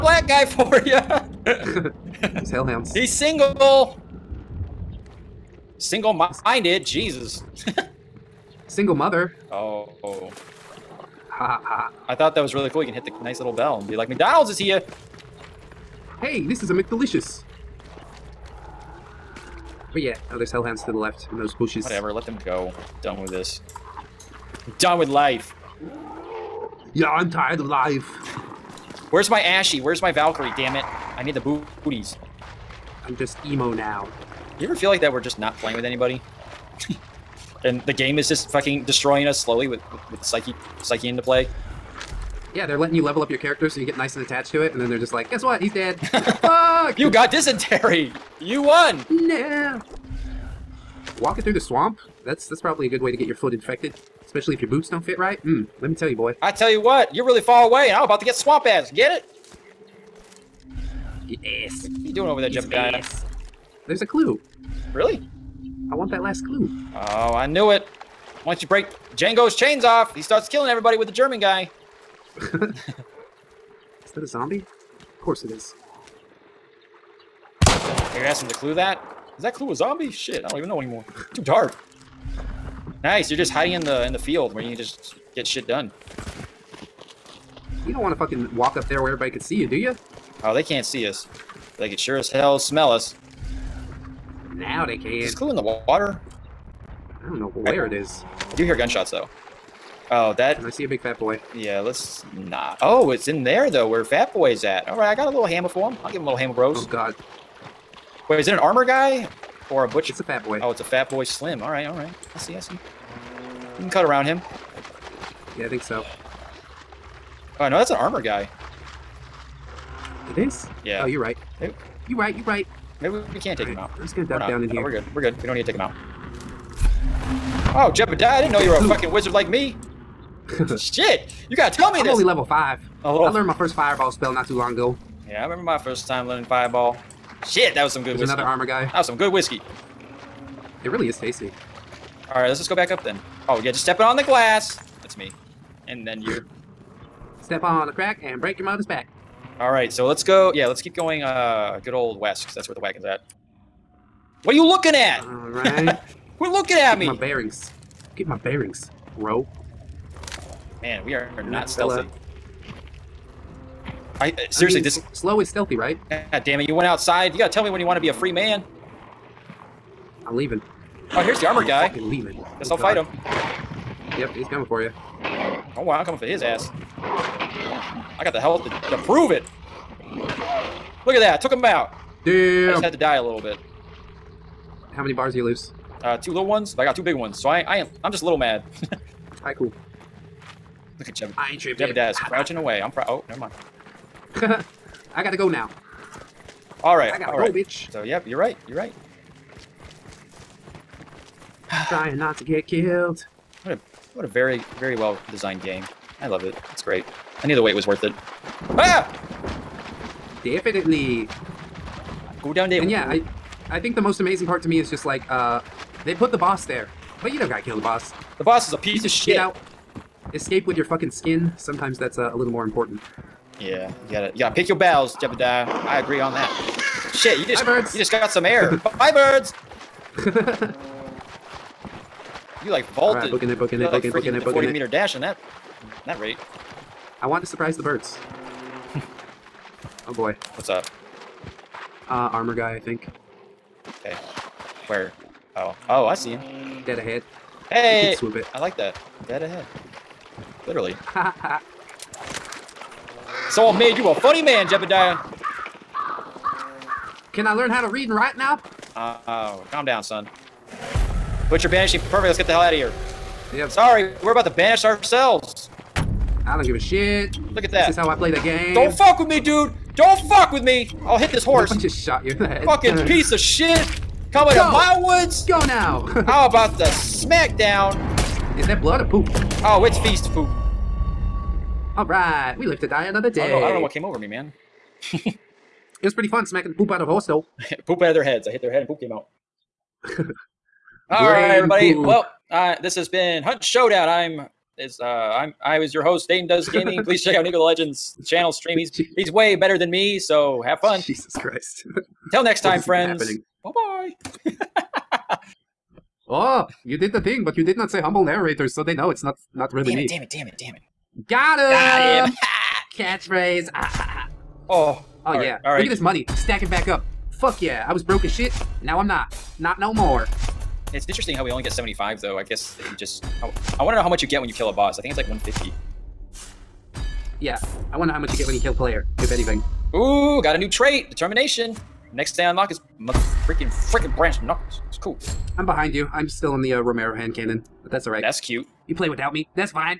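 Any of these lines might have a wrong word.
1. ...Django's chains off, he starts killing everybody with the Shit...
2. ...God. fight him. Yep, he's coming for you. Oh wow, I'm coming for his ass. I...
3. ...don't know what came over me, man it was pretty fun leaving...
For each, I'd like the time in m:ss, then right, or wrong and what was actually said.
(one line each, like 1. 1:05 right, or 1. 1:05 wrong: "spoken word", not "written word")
1. 1:09 wrong: "German", not "Shit"
2. 2:52 right
3. 4:43 wrong: "smacking", not "leaving".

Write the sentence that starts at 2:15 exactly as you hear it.
Yeah, I remember my first time learning fireball.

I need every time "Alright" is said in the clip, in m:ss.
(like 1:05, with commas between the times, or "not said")
2:22, 2:29, 2:35.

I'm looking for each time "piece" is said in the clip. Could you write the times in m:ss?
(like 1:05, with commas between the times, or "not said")
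3:38, 4:33.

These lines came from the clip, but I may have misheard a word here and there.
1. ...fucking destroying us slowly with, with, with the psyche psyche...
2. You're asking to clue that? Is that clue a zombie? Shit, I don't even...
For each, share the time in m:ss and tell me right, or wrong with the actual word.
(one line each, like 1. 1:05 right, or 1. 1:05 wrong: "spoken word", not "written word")
1. 0:38 right
2. 1:18 right.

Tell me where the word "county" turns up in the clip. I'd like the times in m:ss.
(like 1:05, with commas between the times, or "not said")
not said.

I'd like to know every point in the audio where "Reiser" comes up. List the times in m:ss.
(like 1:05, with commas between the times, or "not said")
not said.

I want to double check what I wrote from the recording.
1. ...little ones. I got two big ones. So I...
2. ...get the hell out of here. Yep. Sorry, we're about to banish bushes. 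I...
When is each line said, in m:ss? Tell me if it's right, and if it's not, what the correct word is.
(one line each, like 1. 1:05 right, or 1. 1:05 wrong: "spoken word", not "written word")
1. 3:06 right
2. 4:22 wrong: "ourselves", not "bushes".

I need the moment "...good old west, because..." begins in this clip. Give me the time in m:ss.
2:31.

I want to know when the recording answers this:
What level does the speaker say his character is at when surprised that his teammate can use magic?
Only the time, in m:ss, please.
2:12.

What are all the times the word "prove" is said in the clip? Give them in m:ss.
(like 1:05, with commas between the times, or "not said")
2:59.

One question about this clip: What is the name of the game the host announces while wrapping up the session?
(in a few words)
Hunt Showdown.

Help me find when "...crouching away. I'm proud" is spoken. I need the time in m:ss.
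3:12.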